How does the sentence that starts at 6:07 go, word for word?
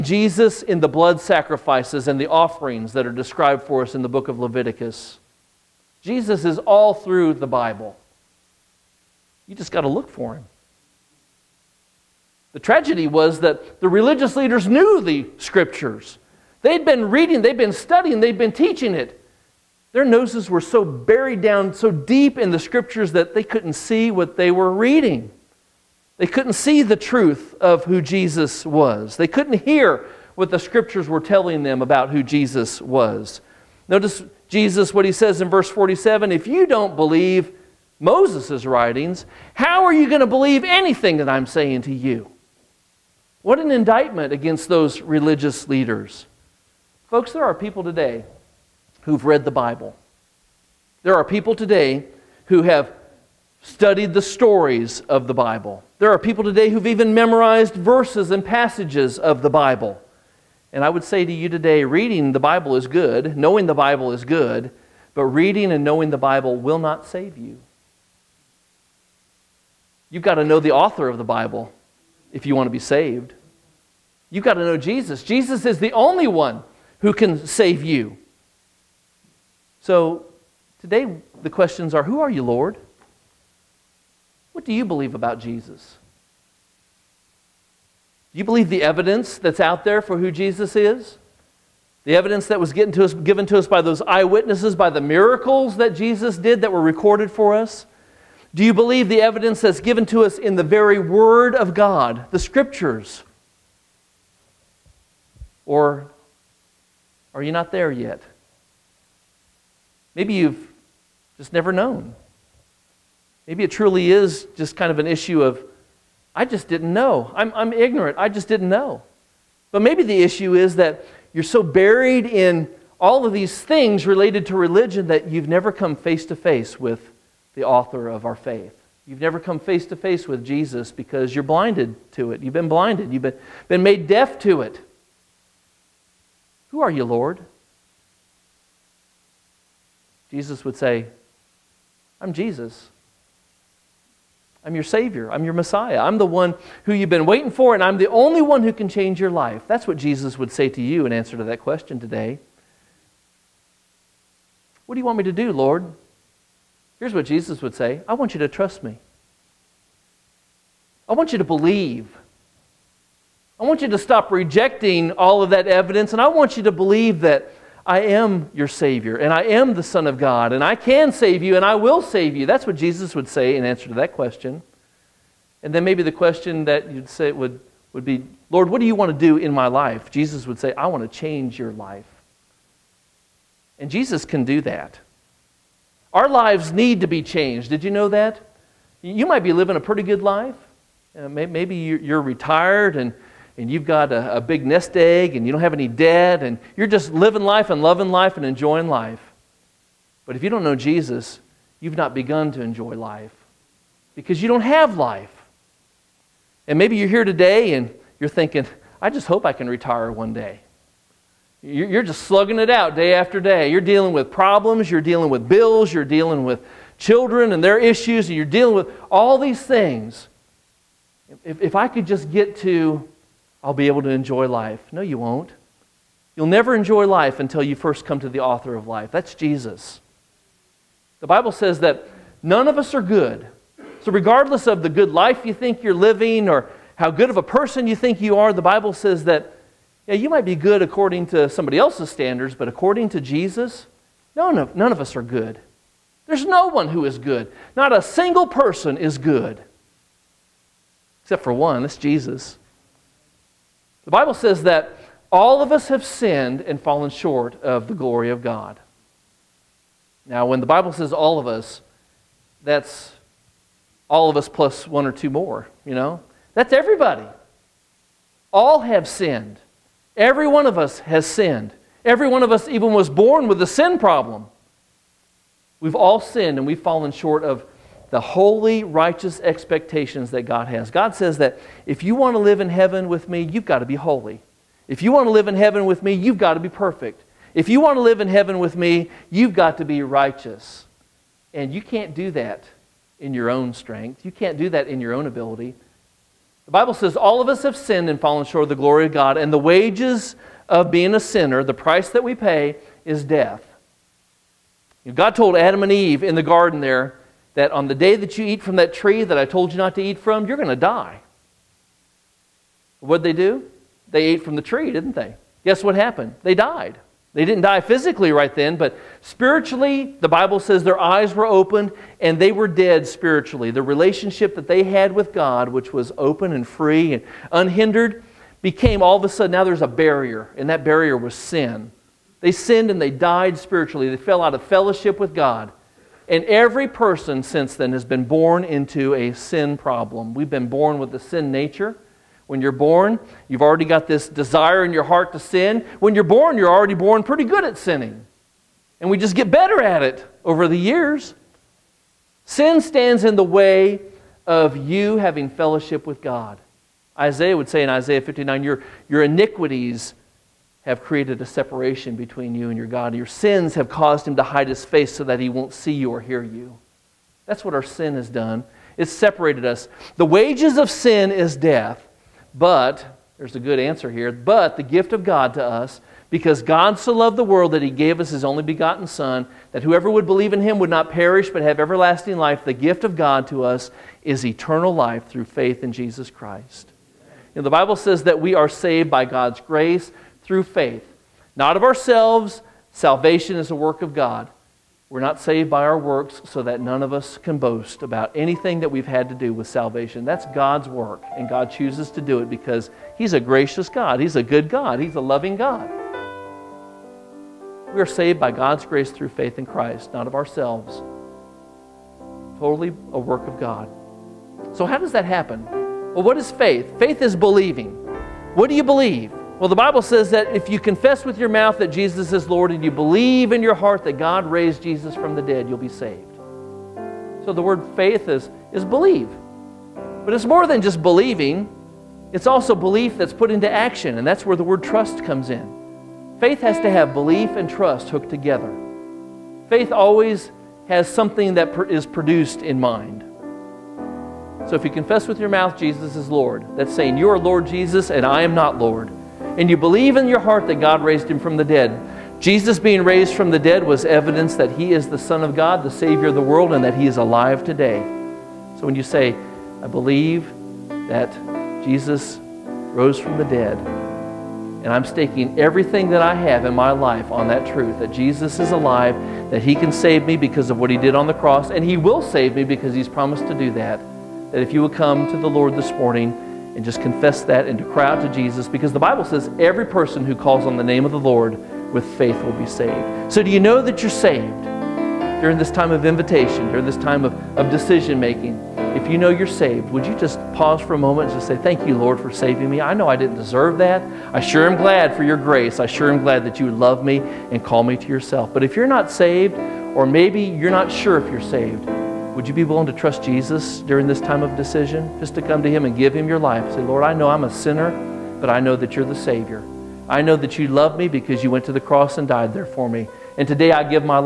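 That's what our sin has done.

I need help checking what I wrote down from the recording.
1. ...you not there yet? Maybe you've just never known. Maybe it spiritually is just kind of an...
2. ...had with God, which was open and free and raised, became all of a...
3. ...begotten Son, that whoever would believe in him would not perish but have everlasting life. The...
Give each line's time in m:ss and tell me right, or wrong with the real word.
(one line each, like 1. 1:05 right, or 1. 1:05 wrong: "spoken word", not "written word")
1. 1:47 wrong: "truly", not "spiritually"
2. 5:24 wrong: "unhindered", not "raised"
3. 6:18 right.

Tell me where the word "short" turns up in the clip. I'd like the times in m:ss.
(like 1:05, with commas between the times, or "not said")
4:17, 4:37, 4:58.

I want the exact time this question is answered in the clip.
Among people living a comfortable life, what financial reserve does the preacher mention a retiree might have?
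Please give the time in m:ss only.
3:14.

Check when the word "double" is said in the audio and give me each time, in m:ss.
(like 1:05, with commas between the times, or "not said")
not said.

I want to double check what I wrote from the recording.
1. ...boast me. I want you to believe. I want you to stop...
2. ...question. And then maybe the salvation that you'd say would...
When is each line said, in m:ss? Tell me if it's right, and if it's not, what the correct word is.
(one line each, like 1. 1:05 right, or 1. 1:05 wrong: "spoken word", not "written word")
1. 2:38 wrong: "trust", not "boast"
2. 2:54 wrong: "question", not "salvation".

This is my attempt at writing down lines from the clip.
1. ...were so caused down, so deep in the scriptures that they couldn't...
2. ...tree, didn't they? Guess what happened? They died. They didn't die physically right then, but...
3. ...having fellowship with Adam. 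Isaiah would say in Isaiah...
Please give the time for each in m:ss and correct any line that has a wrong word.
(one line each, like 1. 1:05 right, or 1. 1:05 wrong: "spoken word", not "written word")
1. 0:20 wrong: "buried", not "caused"
2. 5:14 right
3. 5:55 wrong: "God", not "Adam".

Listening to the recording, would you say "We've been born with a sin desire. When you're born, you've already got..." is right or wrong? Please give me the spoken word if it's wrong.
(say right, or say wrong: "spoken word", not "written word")
wrong: "nature", not "desire".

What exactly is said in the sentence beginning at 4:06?
There's no one who is good.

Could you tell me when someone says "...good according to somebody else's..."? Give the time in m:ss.
4:00.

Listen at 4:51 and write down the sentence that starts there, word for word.
And you can't do that in your own strength.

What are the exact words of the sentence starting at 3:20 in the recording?
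But if you don't know Jesus, you've not begun to enjoy life because you don't have life.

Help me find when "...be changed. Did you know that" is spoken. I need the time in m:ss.
3:07.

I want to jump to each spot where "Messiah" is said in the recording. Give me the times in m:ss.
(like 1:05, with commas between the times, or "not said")
2:25.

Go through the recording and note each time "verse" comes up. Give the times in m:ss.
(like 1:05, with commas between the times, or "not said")
0:35, 0:57.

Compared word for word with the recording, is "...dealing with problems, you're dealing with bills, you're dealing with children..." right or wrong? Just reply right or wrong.
right.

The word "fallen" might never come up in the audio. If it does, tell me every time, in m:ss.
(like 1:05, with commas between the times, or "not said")
4:16, 4:36, 4:58.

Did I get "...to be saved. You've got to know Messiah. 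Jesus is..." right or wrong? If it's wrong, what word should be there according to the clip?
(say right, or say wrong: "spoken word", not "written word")
wrong: "Jesus", not "Messiah".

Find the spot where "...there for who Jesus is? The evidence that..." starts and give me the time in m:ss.
1:29.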